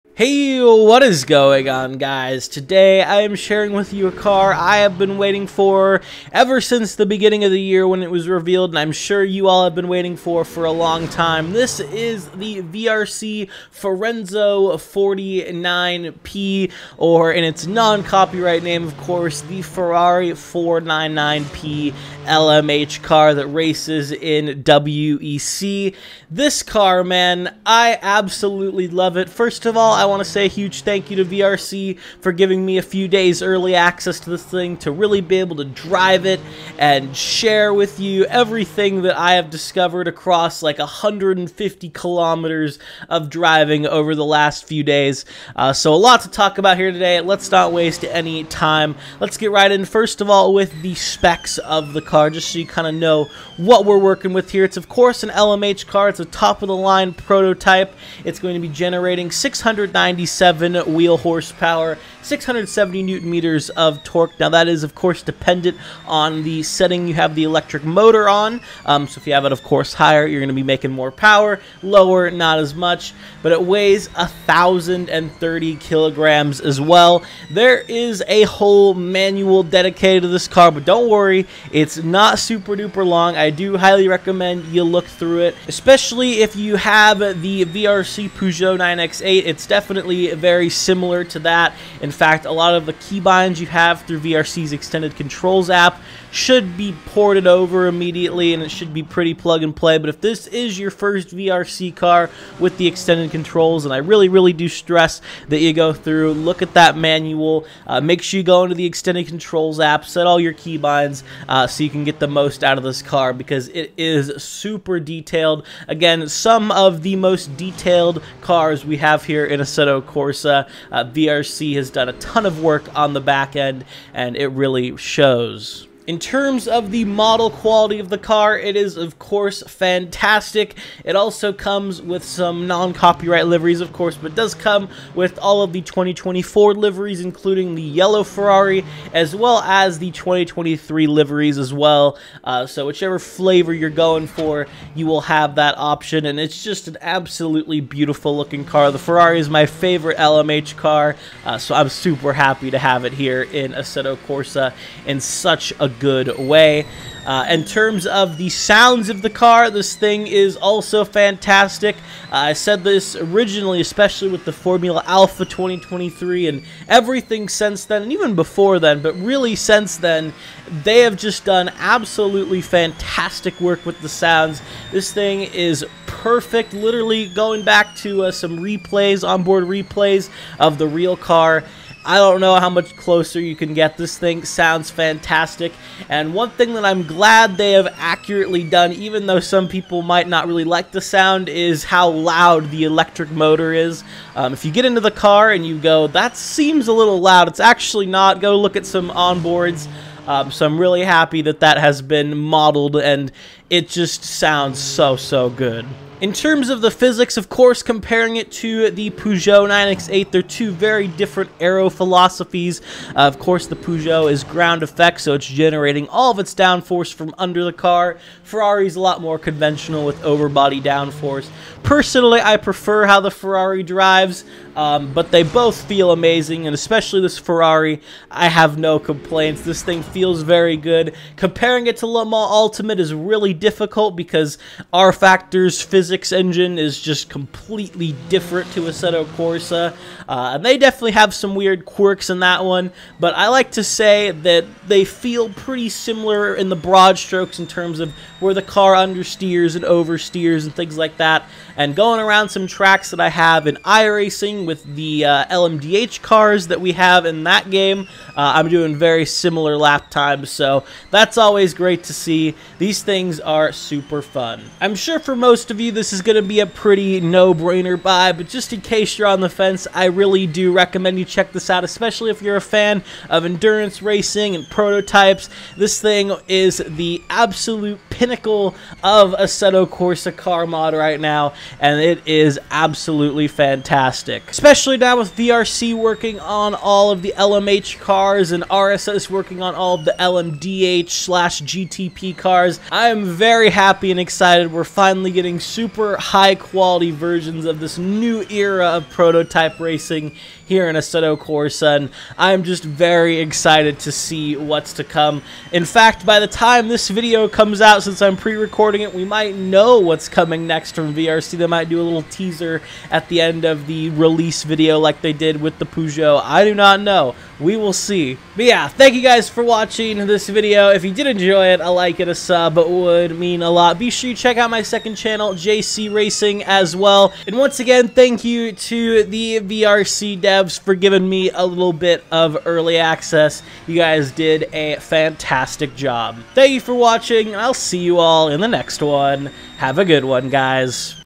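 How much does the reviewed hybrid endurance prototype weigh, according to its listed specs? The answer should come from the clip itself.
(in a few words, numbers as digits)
1,030 kilograms.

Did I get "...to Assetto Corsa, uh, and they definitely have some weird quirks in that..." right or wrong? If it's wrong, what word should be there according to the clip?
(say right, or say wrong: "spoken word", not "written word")
right.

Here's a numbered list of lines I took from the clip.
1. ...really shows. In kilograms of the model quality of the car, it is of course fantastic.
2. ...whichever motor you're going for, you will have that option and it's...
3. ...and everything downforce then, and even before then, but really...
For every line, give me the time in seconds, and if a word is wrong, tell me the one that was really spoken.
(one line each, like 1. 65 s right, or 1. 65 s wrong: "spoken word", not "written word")
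1. 124 s wrong: "terms", not "kilograms"
2. 142 s wrong: "flavor", not "motor"
3. 166 s wrong: "since", not "downforce".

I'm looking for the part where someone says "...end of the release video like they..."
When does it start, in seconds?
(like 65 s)
313 s.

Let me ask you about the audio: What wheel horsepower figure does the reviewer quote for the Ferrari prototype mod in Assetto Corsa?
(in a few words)
697.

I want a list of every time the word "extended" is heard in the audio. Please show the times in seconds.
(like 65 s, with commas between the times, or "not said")
94 s, 102 s, 108 s.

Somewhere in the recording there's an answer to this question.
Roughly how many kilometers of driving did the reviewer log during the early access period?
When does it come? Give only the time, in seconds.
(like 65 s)
40 s.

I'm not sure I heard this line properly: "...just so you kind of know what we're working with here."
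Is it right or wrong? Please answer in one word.
right.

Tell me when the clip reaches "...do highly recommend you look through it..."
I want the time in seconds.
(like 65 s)
83 s.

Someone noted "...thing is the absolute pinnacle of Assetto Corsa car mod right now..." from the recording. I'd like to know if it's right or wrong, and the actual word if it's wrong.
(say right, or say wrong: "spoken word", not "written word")
right.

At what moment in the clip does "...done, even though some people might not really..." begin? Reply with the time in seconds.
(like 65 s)
188 s.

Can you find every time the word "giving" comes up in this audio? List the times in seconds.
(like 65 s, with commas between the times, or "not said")
32 s, 330 s.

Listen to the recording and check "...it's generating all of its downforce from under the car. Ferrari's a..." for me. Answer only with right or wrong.
right.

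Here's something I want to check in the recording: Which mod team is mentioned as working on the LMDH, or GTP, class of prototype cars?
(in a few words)
RSS.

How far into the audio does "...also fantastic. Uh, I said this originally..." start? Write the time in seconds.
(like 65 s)
160 s.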